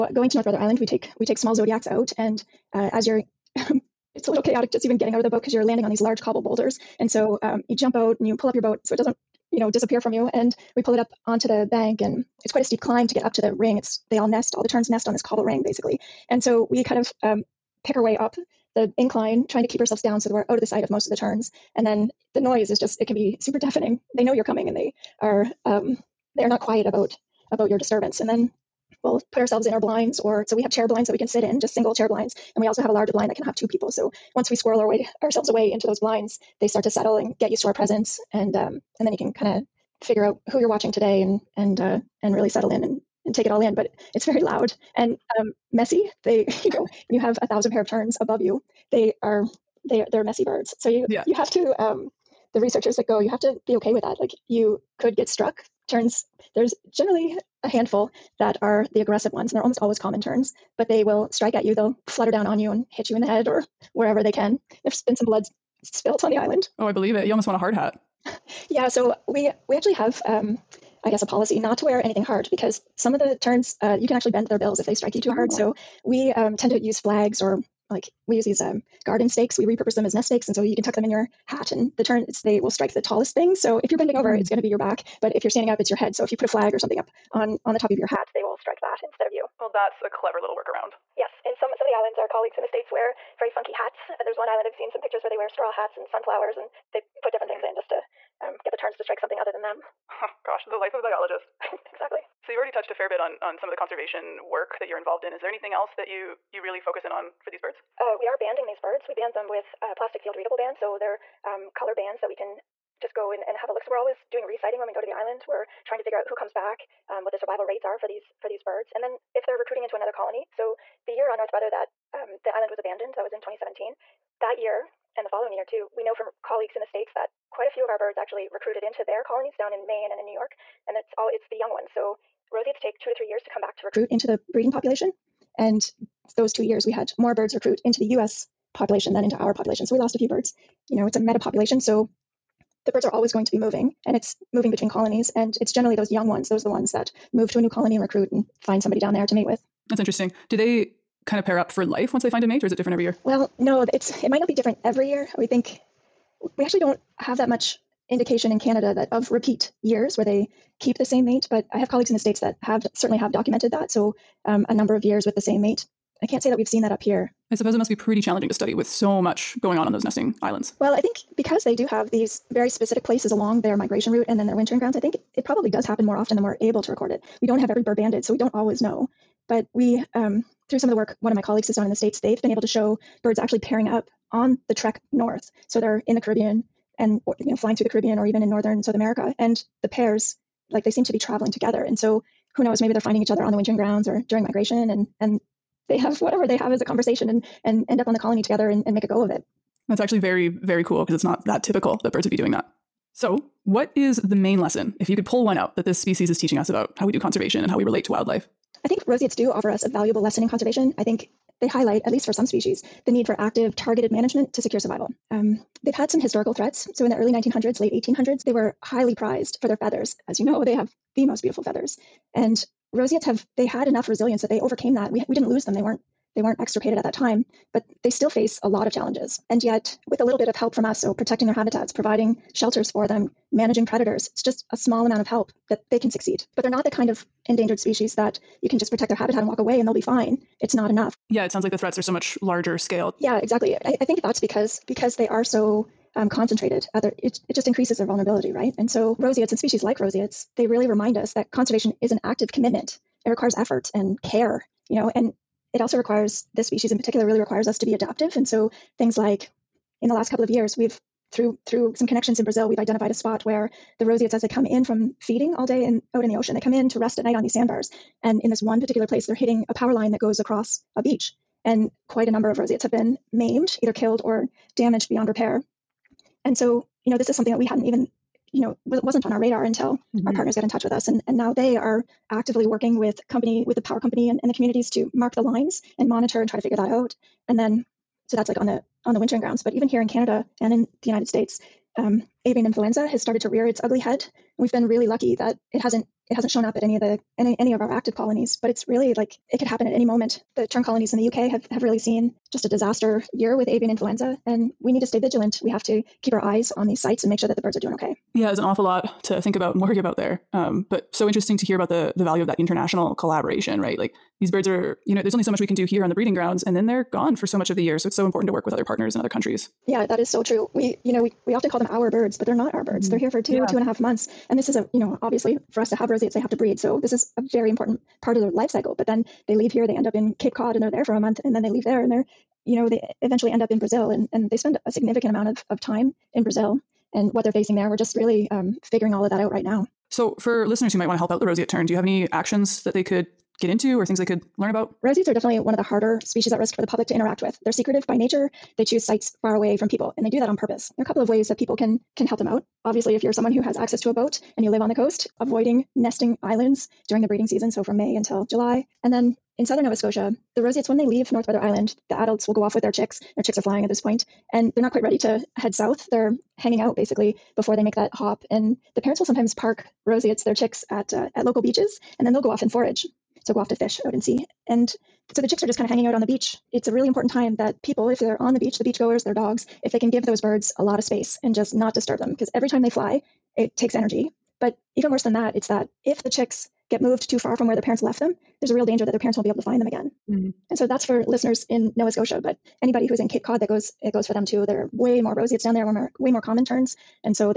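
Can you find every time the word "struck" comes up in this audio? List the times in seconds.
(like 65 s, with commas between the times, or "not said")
55 s.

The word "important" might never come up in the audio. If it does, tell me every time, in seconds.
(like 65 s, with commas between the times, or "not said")
318 s, 327 s, 377 s.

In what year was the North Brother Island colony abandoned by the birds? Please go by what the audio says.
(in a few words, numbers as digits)
2017.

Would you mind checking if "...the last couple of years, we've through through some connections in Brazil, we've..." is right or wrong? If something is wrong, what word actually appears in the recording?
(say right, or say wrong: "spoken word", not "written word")
right.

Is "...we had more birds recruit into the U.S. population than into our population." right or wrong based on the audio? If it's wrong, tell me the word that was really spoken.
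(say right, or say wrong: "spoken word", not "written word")
right.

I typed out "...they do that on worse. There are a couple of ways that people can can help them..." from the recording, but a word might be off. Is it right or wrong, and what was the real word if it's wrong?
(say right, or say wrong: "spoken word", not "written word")
wrong: "purpose", not "worse".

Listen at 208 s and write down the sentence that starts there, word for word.
I think roseates do offer us a valuable lesson in conservation.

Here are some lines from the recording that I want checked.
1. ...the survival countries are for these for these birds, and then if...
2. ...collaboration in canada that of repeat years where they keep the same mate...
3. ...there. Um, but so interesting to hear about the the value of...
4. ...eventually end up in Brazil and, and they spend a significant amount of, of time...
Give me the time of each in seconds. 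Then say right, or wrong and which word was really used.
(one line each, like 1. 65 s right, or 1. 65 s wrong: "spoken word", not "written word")
1. 117 s wrong: "rates", not "countries"
2. 158 s wrong: "indication", not "collaboration"
3. 310 s right
4. 333 s right.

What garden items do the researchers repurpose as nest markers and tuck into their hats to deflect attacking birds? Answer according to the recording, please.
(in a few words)
garden stakes.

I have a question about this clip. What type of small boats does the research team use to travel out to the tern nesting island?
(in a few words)
zodiacs.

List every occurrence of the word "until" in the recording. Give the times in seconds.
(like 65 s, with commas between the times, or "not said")
279 s, 358 s.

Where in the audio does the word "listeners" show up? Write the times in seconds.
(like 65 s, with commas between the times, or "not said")
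340 s, 391 s.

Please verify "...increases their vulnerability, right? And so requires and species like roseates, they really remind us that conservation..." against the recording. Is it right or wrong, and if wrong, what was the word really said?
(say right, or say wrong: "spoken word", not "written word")
wrong: "roseates", not "requires".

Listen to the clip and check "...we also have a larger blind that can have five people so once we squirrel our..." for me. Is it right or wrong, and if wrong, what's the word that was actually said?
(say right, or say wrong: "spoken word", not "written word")
wrong: "two", not "five".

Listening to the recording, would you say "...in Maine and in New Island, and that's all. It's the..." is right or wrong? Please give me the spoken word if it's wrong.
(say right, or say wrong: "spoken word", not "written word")
wrong: "York", not "Island".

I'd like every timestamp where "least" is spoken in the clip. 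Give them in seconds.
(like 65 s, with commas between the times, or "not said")
212 s.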